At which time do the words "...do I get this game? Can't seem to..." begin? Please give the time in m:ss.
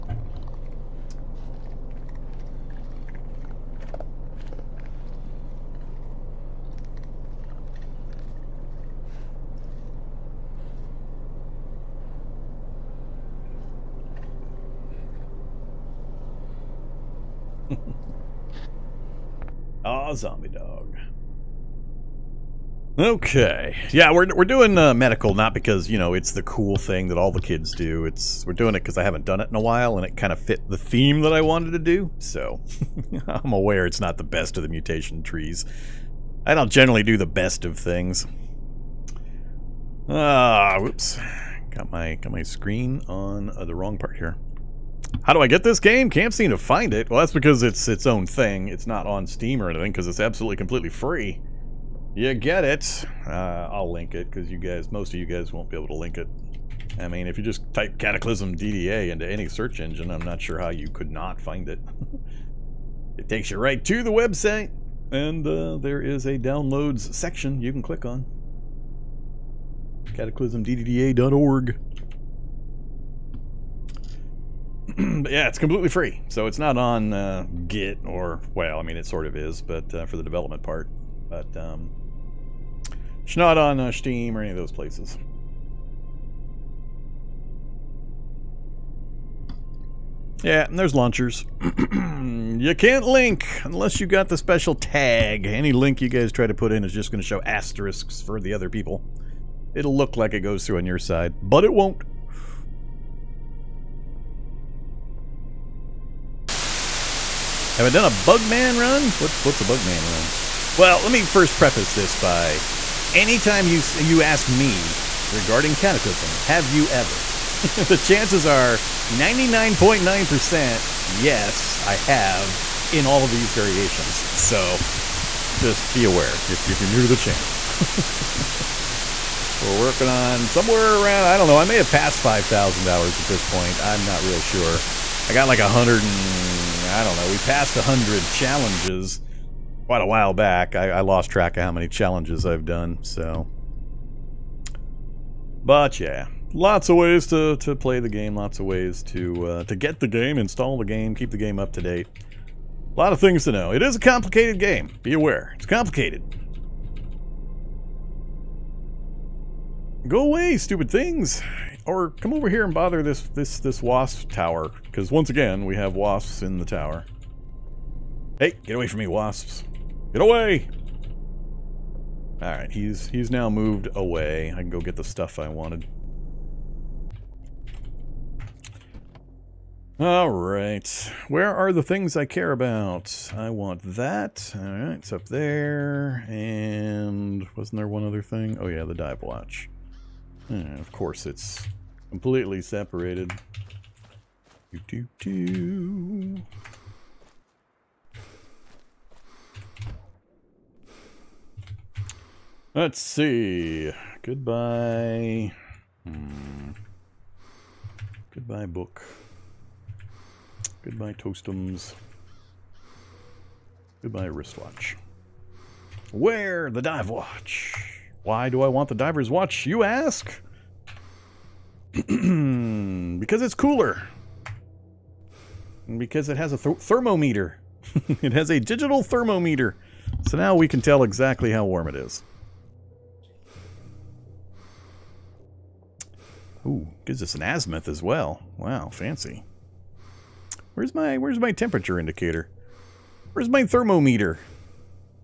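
0:45.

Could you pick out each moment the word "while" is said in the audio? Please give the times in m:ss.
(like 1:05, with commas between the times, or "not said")
0:29, 2:20.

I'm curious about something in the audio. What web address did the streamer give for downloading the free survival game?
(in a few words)
CataclysmDDA.org.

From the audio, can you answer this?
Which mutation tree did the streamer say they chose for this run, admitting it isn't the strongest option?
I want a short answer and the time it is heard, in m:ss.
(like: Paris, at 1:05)
Medical, at 0:24.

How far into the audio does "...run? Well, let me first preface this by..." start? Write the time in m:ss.
1:50.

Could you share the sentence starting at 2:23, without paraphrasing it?
So, but yeah, lots of ways to to play the game.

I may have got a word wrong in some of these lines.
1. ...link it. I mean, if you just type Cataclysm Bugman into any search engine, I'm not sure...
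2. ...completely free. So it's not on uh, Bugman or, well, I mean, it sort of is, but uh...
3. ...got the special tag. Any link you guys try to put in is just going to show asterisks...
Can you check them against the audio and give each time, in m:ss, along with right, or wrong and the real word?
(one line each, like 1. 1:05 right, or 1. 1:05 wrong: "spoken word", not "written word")
1. 0:55 wrong: "DDA", not "Bugman"
2. 1:15 wrong: "Git", not "Bugman"
3. 1:34 right.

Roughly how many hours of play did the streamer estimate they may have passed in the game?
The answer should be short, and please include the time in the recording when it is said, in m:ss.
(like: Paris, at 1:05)
5,000, at 2:12.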